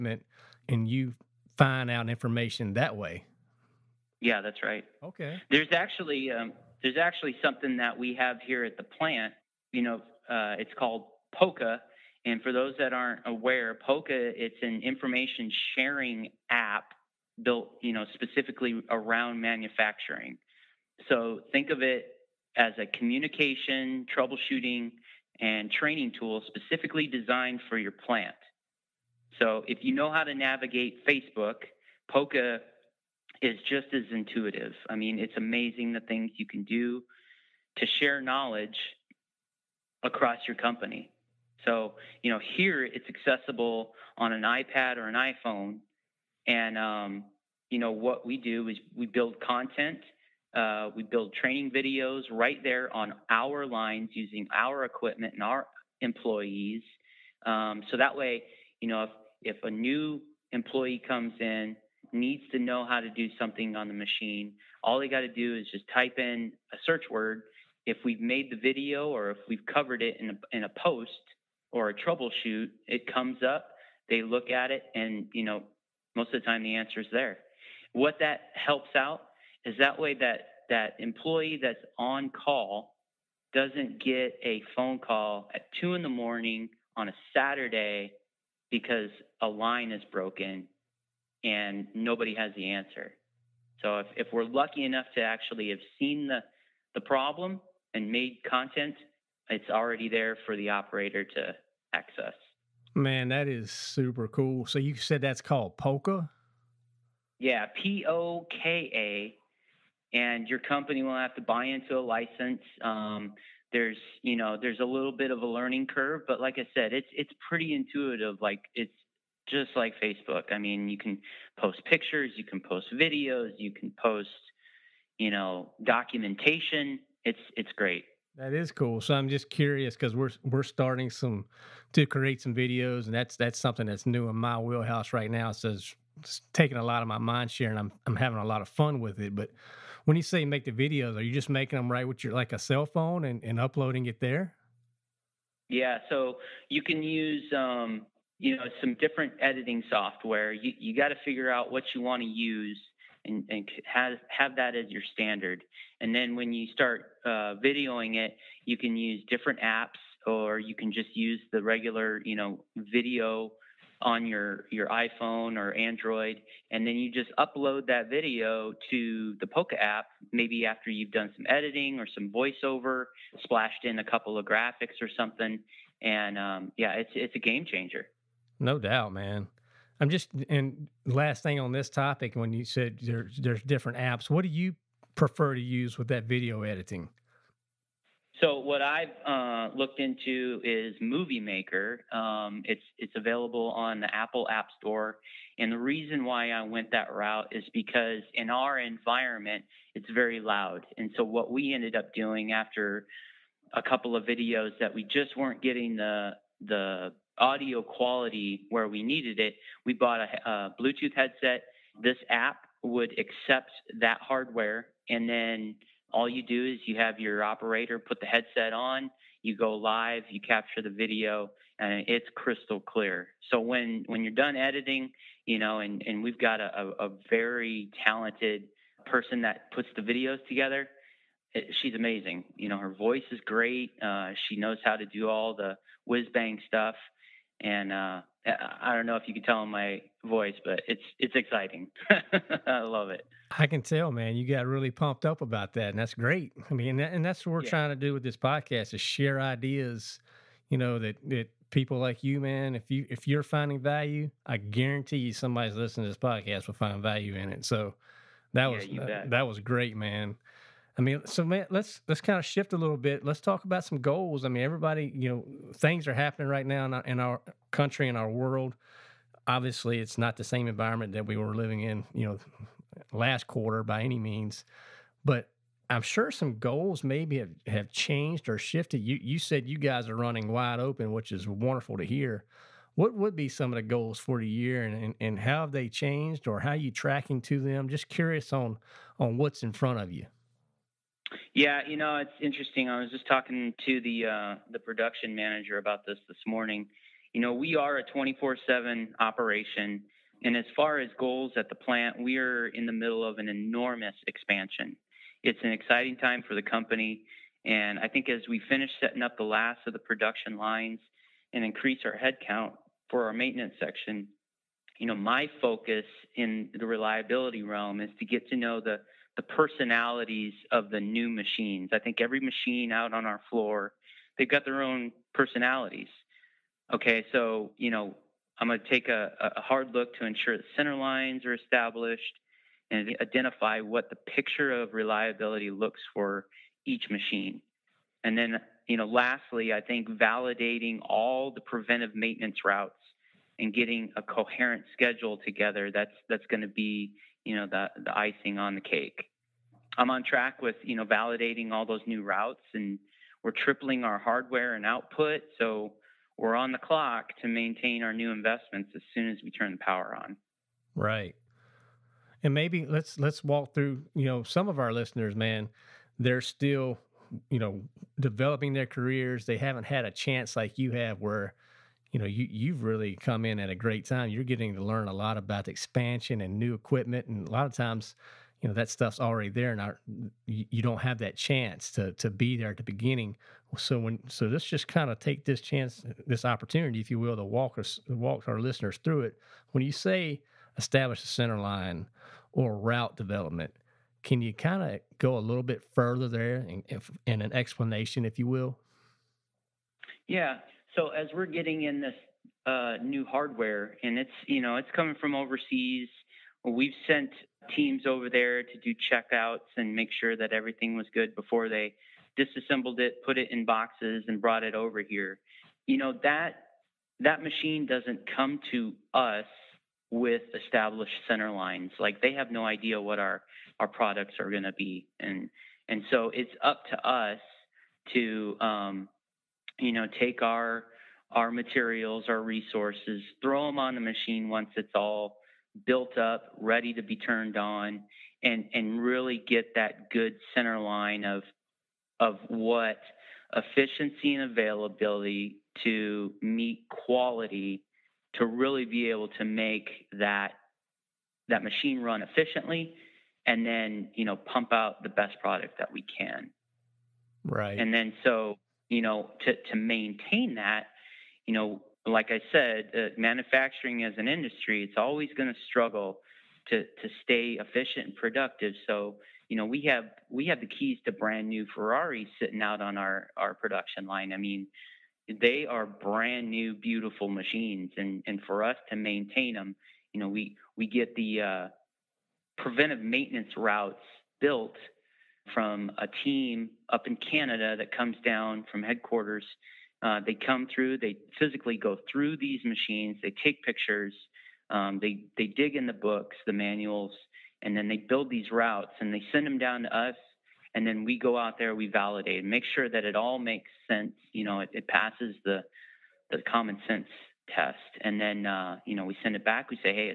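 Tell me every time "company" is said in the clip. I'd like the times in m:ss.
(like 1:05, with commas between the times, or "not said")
0:40, 1:50, 5:06.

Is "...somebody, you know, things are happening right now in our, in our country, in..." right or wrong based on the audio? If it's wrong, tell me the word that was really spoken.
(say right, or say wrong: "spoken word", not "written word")
wrong: "everybody", not "somebody".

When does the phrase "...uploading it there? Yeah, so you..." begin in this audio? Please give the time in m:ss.
2:23.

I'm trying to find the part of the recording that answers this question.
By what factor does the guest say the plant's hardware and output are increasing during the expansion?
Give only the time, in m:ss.
5:53.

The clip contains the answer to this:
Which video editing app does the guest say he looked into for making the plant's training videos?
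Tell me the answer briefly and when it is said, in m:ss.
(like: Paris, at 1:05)
Movie Maker, at 3:11.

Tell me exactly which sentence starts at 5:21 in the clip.
I think every machine out on our floor, they've got their own personalities.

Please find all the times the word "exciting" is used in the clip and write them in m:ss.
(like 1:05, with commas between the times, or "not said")
4:01, 5:05.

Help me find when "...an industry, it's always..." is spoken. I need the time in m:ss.
7:44.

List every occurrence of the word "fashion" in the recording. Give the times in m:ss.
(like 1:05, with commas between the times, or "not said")
not said.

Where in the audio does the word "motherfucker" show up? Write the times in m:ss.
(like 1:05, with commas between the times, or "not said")
not said.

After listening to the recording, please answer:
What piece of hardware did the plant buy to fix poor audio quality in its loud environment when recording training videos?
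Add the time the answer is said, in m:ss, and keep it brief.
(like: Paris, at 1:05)
Bluetooth headset, at 3:30.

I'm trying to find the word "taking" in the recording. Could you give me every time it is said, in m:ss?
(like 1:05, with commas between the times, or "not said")
2:16.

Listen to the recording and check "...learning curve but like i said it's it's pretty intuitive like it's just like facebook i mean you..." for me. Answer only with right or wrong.
right.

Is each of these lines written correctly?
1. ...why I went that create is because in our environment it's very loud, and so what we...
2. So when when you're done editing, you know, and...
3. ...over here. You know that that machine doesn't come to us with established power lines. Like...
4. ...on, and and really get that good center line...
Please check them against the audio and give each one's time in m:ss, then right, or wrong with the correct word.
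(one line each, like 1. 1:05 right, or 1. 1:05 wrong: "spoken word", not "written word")
1. 3:16 wrong: "route", not "create"
2. 3:43 right
3. 6:54 wrong: "center", not "power"
4. 7:17 right.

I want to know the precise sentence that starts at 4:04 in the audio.
You got really pumped up about that, and that's great.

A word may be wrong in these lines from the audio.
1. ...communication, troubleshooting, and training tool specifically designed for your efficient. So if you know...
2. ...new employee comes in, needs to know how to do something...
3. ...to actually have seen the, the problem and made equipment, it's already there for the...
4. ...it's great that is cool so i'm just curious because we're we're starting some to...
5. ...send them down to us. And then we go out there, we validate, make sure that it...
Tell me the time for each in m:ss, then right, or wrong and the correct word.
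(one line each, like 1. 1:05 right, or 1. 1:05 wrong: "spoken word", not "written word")
1. 0:22 wrong: "plant", not "efficient"
2. 0:59 right
3. 1:35 wrong: "content", not "equipment"
4. 2:07 right
5. 8:19 right.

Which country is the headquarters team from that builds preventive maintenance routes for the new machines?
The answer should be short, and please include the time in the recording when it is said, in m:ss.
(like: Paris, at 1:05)
Canada, at 8:07.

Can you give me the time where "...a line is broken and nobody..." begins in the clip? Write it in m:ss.
1:29.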